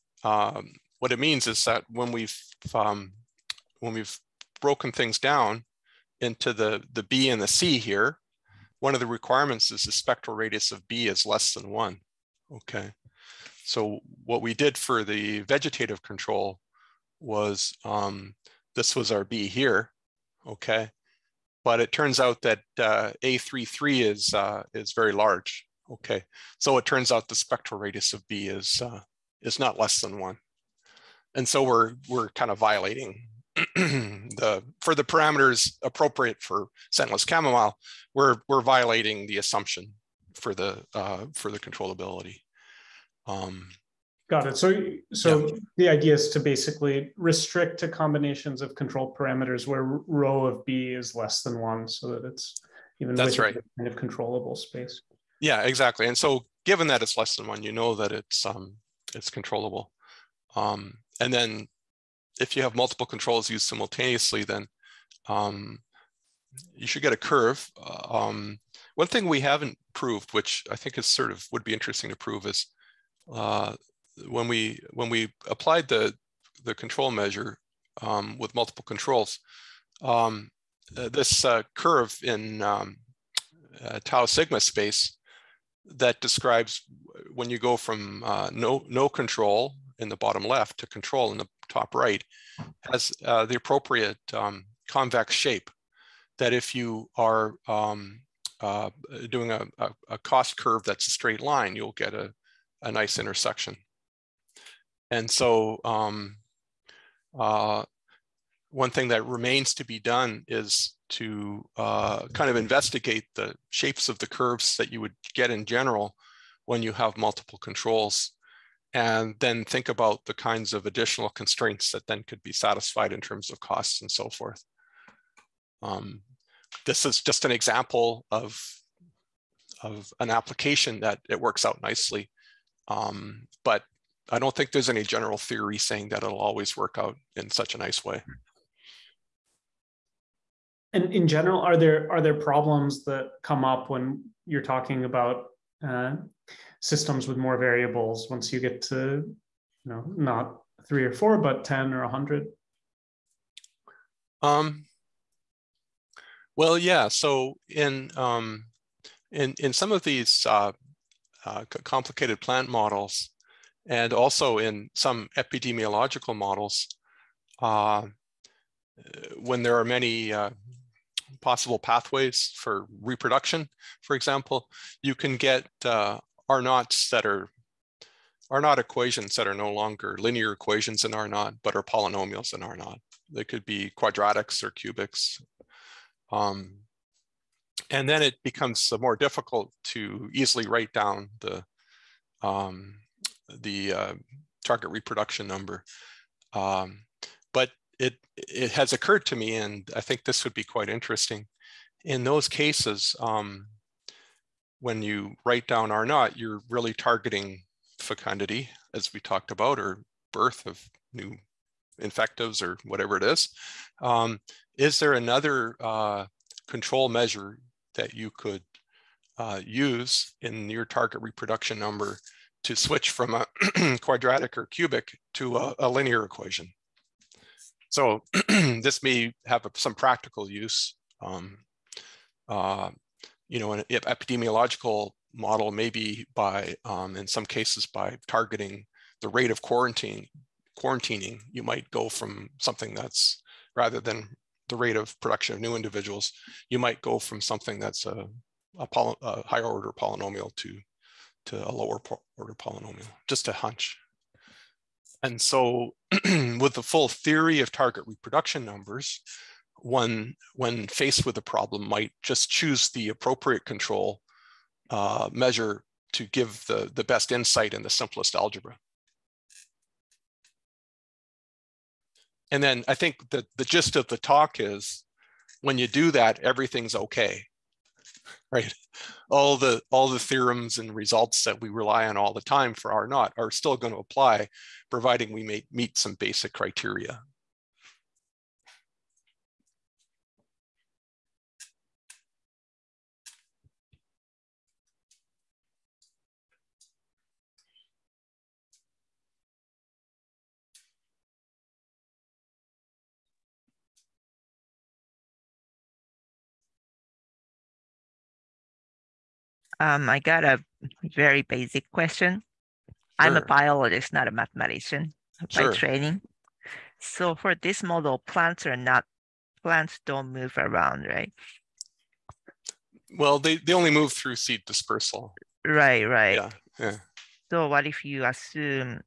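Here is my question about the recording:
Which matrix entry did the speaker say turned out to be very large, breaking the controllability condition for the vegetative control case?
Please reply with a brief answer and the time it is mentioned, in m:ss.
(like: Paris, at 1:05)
A33, at 0:23.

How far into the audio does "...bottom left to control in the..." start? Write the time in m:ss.
1:30.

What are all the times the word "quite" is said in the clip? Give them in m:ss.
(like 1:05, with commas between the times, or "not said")
3:20.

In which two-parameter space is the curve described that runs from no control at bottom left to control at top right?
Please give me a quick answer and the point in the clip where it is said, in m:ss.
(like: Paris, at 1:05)
Tau sigma space, at 1:24.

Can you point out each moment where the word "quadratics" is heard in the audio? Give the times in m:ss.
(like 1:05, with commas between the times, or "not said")
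3:03, 3:44.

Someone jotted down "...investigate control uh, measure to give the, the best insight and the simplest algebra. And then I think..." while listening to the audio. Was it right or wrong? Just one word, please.
wrong.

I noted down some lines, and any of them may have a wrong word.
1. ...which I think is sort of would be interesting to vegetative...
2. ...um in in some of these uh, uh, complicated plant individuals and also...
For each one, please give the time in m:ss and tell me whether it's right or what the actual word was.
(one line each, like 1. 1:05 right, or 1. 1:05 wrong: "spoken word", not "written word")
1. 1:10 wrong: "prove", not "vegetative"
2. 2:38 wrong: "models", not "individuals".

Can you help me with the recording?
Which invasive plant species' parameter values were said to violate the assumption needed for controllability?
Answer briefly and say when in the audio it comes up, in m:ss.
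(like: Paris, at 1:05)
Scentless chamomile, at 0:36.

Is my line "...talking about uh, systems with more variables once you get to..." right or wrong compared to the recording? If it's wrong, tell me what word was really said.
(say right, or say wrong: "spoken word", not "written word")
right.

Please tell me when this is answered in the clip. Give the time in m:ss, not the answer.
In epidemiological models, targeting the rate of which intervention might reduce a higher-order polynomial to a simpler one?
3:59.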